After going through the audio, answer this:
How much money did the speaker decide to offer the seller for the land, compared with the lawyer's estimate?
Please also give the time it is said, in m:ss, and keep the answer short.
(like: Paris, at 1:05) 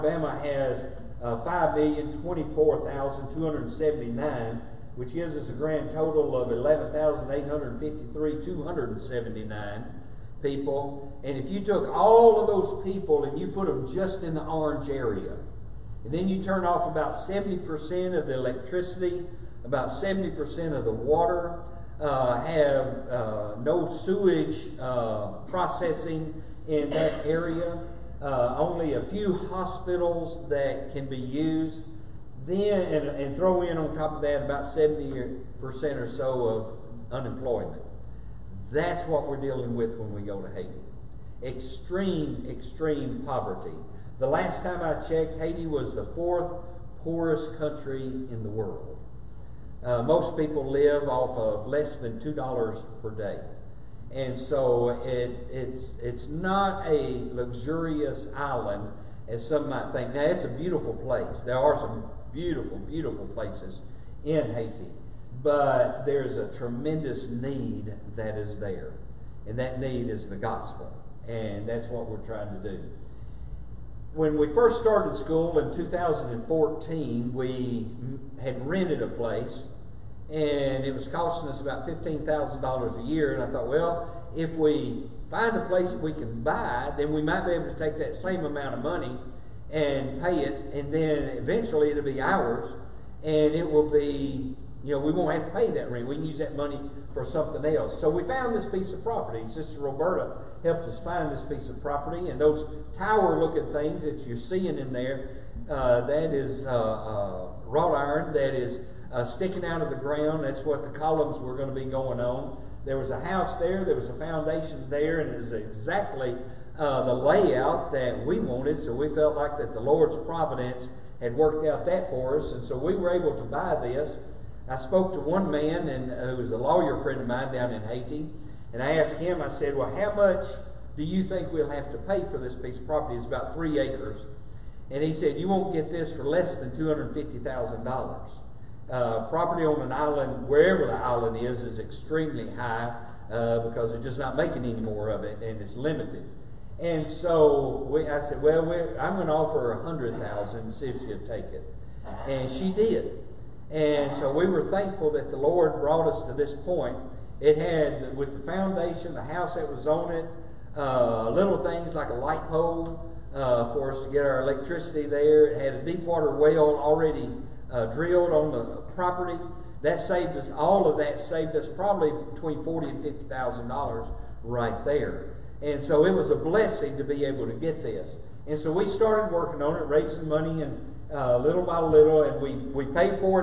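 $100,000, at 2:29.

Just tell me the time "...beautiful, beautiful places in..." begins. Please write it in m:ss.
1:02.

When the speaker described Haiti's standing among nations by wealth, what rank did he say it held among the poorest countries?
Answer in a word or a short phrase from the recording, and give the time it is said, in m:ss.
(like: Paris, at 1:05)
fourth, at 0:46.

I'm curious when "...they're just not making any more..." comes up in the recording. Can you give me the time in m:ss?
2:23.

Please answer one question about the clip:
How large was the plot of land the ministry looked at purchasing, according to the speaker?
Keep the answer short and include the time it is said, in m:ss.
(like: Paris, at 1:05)
about 3 acres, at 2:13.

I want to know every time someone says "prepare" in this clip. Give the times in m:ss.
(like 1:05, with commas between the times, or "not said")
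not said.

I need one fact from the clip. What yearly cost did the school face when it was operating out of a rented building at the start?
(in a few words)
$15,000.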